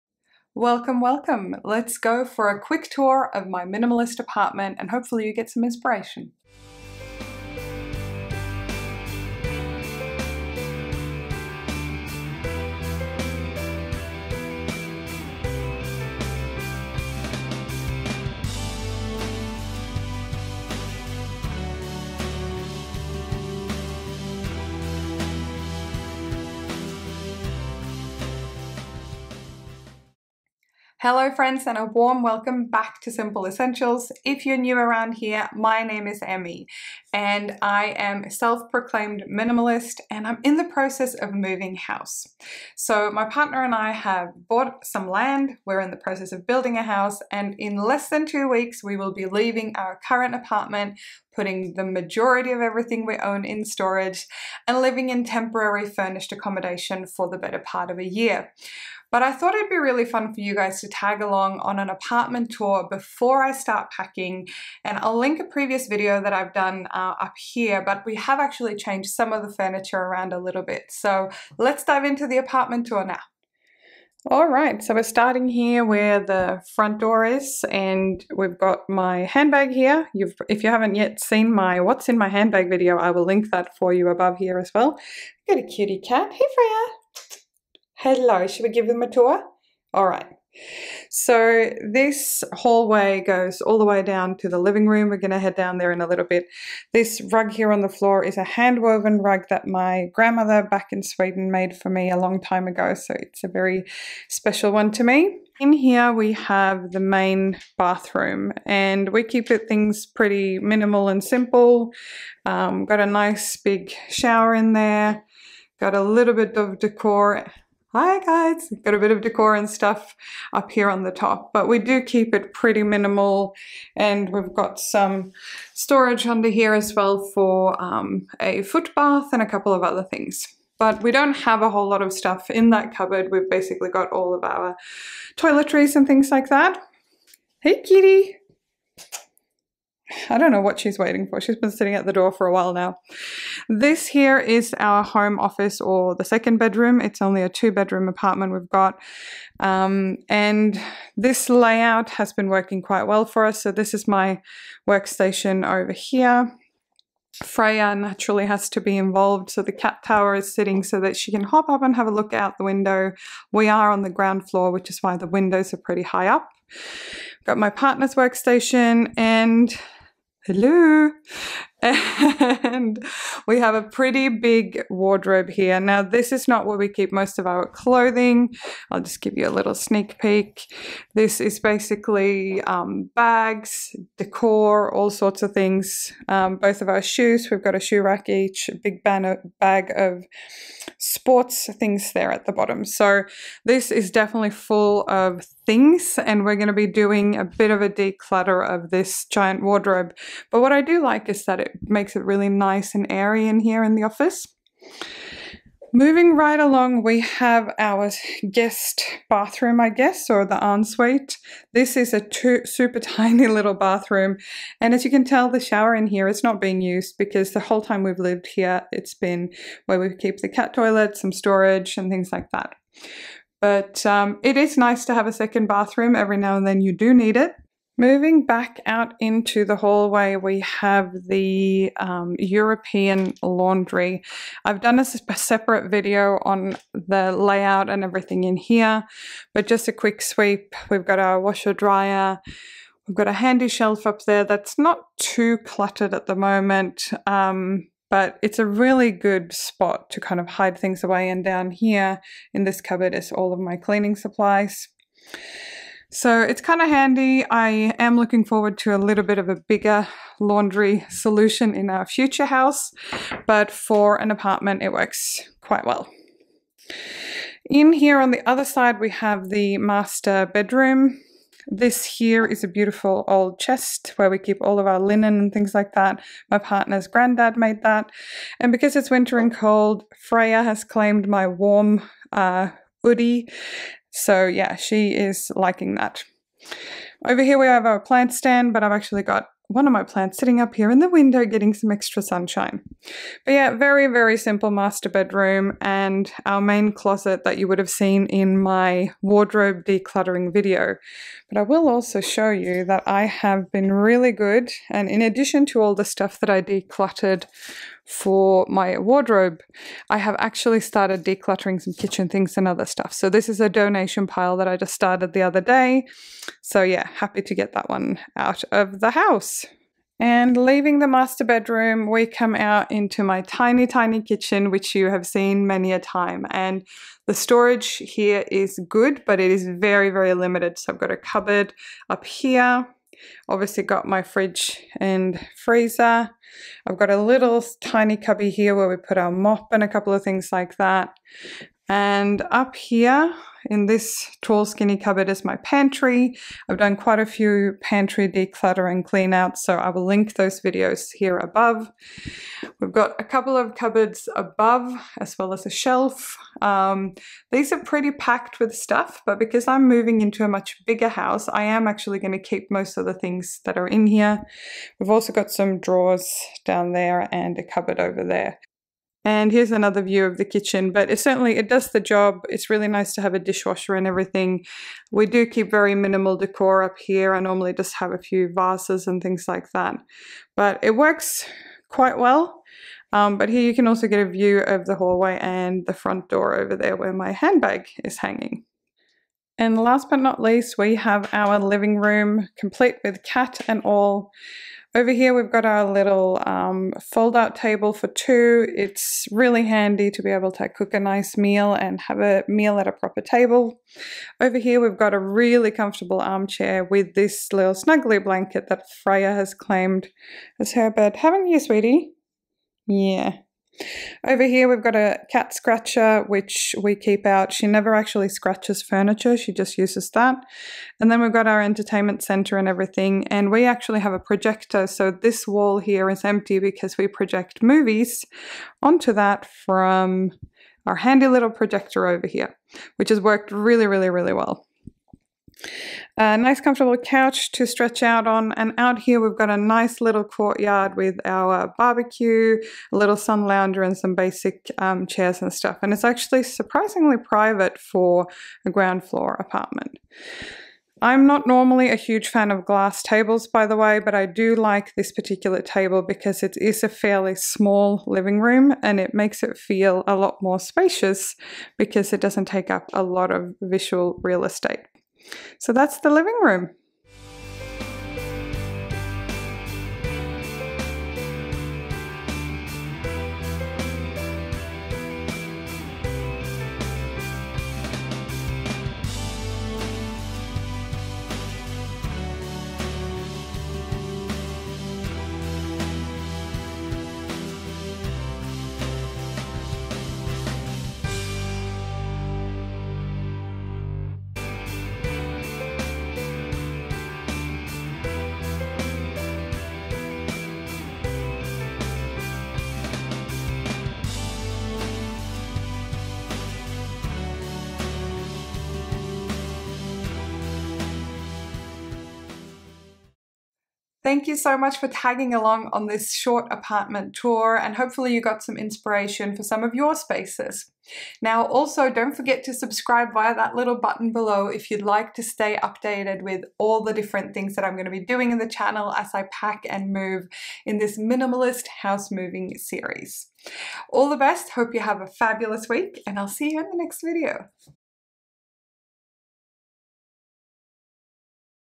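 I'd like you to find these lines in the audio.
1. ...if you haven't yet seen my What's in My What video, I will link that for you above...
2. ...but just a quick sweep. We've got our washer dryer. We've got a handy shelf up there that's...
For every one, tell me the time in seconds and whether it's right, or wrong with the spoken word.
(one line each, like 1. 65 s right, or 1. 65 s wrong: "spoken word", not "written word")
1. 80 s wrong: "Handbag", not "What"
2. 239 s right.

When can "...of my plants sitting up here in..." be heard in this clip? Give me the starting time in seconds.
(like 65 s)
289 s.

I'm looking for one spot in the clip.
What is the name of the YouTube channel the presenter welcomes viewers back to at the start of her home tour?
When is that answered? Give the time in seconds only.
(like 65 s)
33 s.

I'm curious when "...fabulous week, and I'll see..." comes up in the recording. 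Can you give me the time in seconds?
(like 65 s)
535 s.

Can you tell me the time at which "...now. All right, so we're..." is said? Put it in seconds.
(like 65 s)
73 s.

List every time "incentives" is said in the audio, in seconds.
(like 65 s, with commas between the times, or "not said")
not said.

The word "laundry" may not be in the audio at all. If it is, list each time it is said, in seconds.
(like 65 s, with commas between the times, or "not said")
233 s, 260 s.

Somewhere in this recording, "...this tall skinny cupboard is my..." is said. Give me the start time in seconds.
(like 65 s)
343 s.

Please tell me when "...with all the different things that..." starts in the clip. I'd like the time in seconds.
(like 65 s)
526 s.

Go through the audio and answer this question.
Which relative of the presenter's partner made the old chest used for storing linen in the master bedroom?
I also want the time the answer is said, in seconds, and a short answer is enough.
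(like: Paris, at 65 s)
granddad, at 277 s.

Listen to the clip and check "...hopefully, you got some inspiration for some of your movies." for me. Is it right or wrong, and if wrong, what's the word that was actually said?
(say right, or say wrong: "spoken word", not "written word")
wrong: "spaces", not "movies".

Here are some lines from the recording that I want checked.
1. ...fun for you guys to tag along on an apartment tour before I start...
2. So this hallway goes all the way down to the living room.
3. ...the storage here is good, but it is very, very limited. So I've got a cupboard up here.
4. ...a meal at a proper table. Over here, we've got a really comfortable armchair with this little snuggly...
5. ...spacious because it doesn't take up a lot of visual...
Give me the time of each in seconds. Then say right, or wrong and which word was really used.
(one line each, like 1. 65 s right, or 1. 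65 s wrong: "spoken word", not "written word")
1. 60 s right
2. 91 s right
3. 327 s right
4. 402 s right
5. 460 s right.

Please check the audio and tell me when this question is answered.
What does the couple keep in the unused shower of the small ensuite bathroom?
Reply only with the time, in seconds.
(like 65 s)
220 s.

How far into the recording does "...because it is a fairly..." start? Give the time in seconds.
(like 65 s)
456 s.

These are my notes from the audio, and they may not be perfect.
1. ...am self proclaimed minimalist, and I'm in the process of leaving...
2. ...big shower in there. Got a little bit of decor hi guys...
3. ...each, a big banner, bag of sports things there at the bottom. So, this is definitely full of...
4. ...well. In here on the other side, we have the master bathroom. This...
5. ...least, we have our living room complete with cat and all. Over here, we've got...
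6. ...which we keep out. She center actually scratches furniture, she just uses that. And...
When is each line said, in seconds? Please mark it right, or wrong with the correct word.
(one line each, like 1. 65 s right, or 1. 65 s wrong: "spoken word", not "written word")
1. 37 s wrong: "moving", not "leaving"
2. 113 s right
3. 188 s right
4. 265 s wrong: "bedroom", not "bathroom"
5. 390 s right
6. 416 s wrong: "never", not "center".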